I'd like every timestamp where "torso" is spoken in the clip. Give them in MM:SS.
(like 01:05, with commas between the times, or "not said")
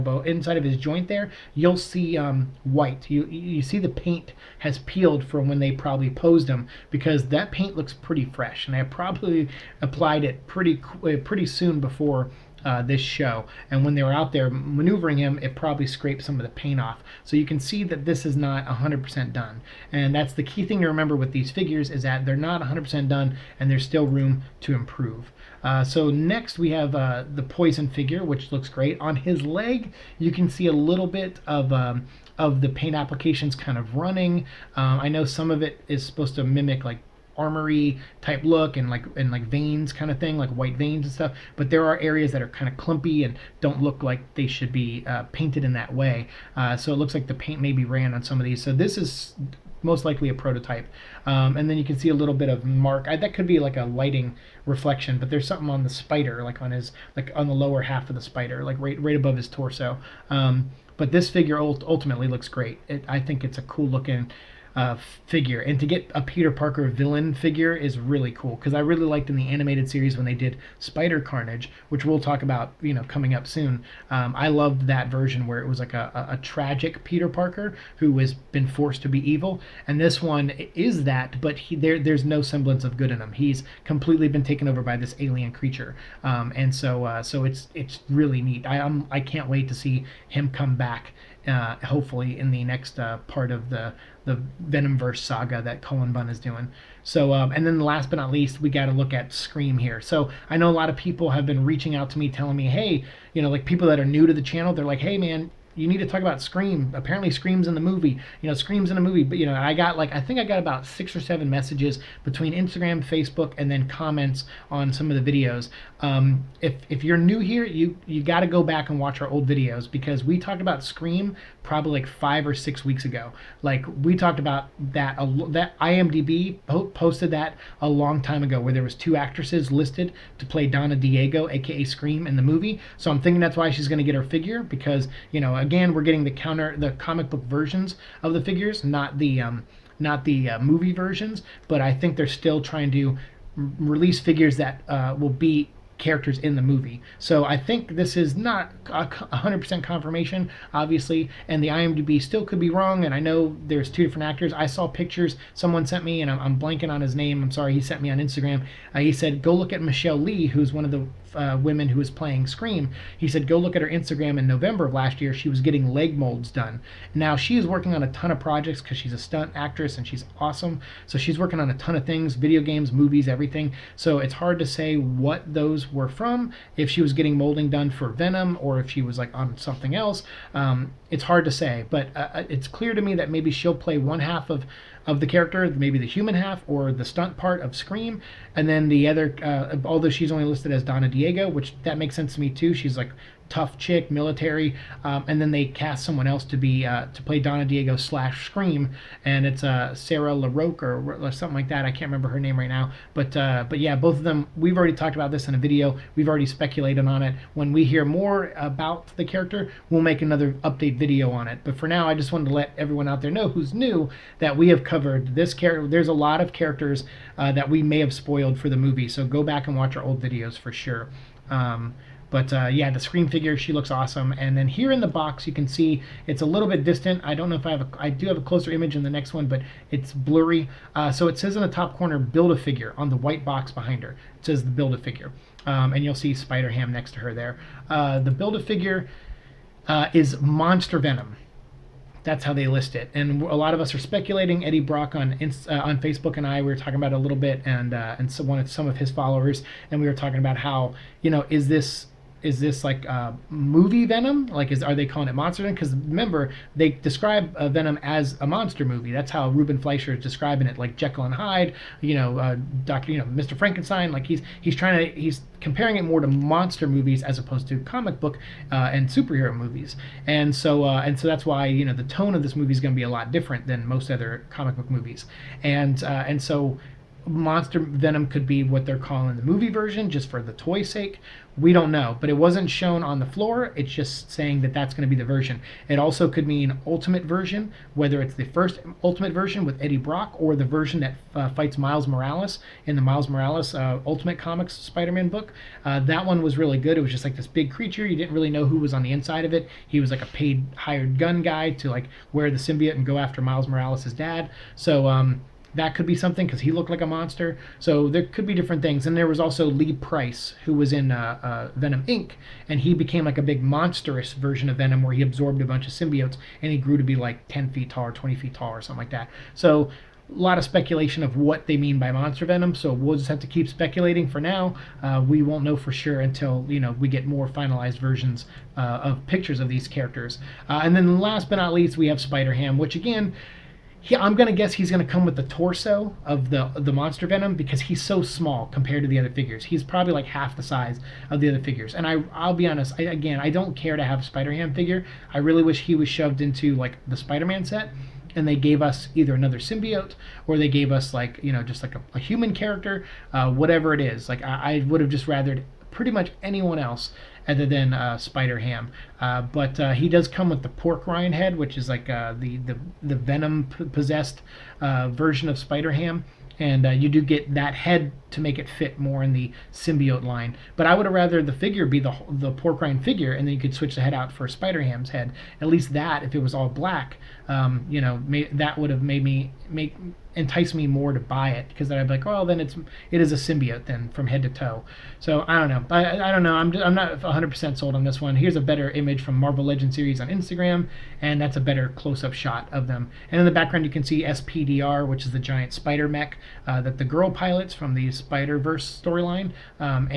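00:59, 05:35.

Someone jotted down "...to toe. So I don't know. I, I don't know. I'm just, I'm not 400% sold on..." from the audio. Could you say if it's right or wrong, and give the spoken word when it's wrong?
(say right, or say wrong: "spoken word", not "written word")
wrong: "100", not "400".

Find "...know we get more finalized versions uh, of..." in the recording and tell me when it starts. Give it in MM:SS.
05:26.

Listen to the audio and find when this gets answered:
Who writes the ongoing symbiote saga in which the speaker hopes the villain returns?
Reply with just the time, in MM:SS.
01:35.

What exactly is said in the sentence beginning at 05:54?
Like I, I would have just rathered pretty much anyone else other than uh, Spider Ham.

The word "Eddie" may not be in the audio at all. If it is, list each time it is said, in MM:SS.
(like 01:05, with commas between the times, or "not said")
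04:04, 04:49.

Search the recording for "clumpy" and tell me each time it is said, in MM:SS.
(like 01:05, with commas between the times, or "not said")
00:42.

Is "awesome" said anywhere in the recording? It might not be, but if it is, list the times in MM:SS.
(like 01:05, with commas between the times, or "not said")
02:50, 03:43.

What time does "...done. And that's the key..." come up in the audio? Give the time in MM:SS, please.
00:19.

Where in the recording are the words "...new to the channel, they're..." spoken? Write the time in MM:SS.
01:44.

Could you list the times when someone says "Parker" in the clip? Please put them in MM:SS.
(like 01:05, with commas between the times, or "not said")
01:06, 01:17.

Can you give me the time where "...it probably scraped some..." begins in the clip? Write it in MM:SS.
00:15.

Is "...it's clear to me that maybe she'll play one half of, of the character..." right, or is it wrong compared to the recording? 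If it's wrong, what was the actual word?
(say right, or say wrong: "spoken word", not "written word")
right.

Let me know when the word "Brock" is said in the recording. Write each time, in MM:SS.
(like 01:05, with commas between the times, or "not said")
04:04, 04:49.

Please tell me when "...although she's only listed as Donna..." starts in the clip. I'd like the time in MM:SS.
03:09.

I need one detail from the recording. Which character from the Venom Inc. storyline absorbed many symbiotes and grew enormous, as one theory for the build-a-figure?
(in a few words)
Lee Price.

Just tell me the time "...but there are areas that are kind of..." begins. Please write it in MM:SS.
00:41.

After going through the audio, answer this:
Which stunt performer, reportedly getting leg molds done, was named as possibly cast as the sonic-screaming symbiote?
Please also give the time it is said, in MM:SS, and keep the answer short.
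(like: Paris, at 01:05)
Michelle Lee, at 02:39.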